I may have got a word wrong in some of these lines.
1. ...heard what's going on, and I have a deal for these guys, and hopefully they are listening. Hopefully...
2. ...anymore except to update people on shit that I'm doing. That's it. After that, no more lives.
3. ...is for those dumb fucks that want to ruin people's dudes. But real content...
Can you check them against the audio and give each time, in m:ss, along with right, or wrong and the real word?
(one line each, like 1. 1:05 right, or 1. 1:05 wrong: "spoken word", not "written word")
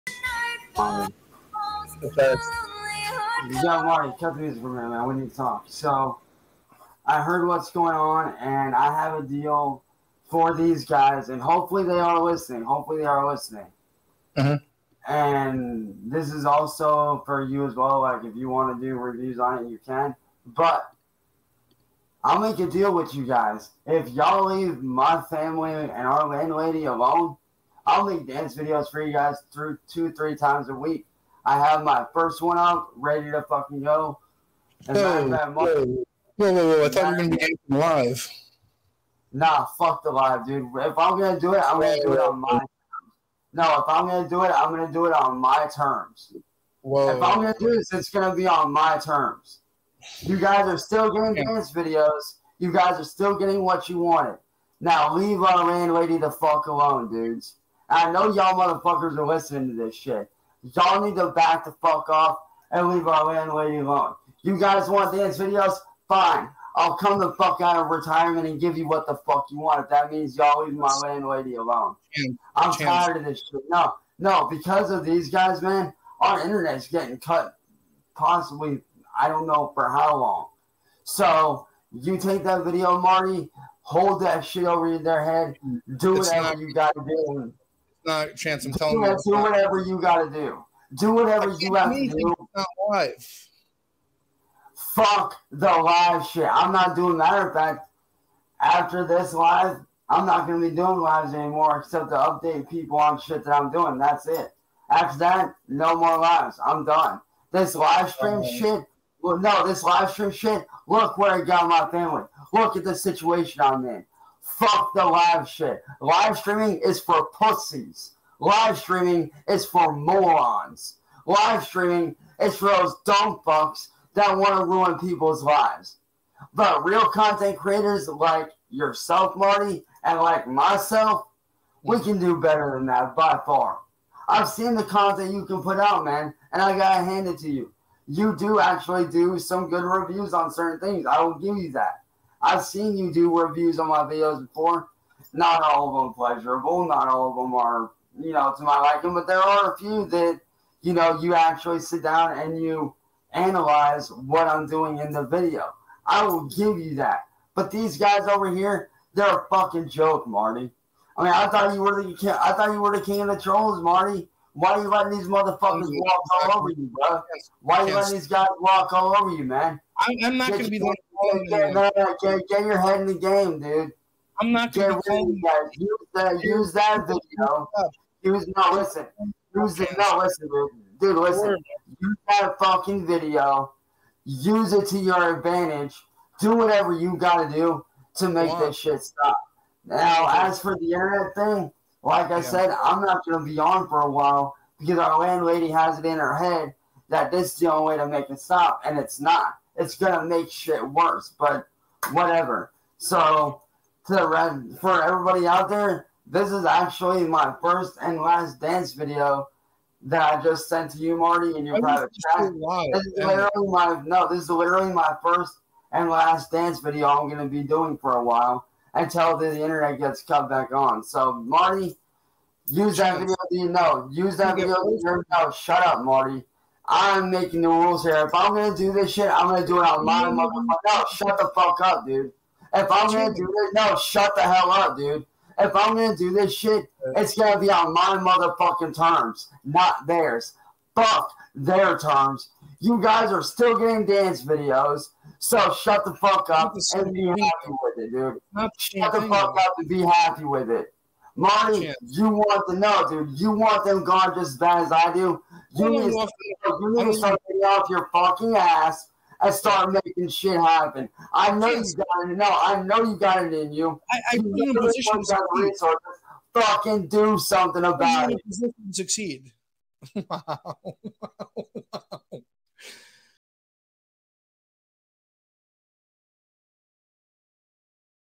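1. 0:07 right
2. 1:41 right
3. 2:02 wrong: "lives", not "dudes".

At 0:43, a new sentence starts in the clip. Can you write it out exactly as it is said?
No, if I'm gonna do it, I'm gonna do it on my terms.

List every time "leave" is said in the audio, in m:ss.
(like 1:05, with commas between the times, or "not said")
0:24, 0:55, 1:02, 1:10.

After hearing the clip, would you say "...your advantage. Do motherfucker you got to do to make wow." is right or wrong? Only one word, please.
wrong.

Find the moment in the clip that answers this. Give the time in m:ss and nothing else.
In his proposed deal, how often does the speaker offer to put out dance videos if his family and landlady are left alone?
0:29.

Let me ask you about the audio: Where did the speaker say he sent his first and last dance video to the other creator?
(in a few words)
Private chat.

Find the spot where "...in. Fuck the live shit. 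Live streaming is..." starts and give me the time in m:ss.
1:53.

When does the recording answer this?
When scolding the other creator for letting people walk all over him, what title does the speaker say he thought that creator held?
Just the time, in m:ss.
2:43.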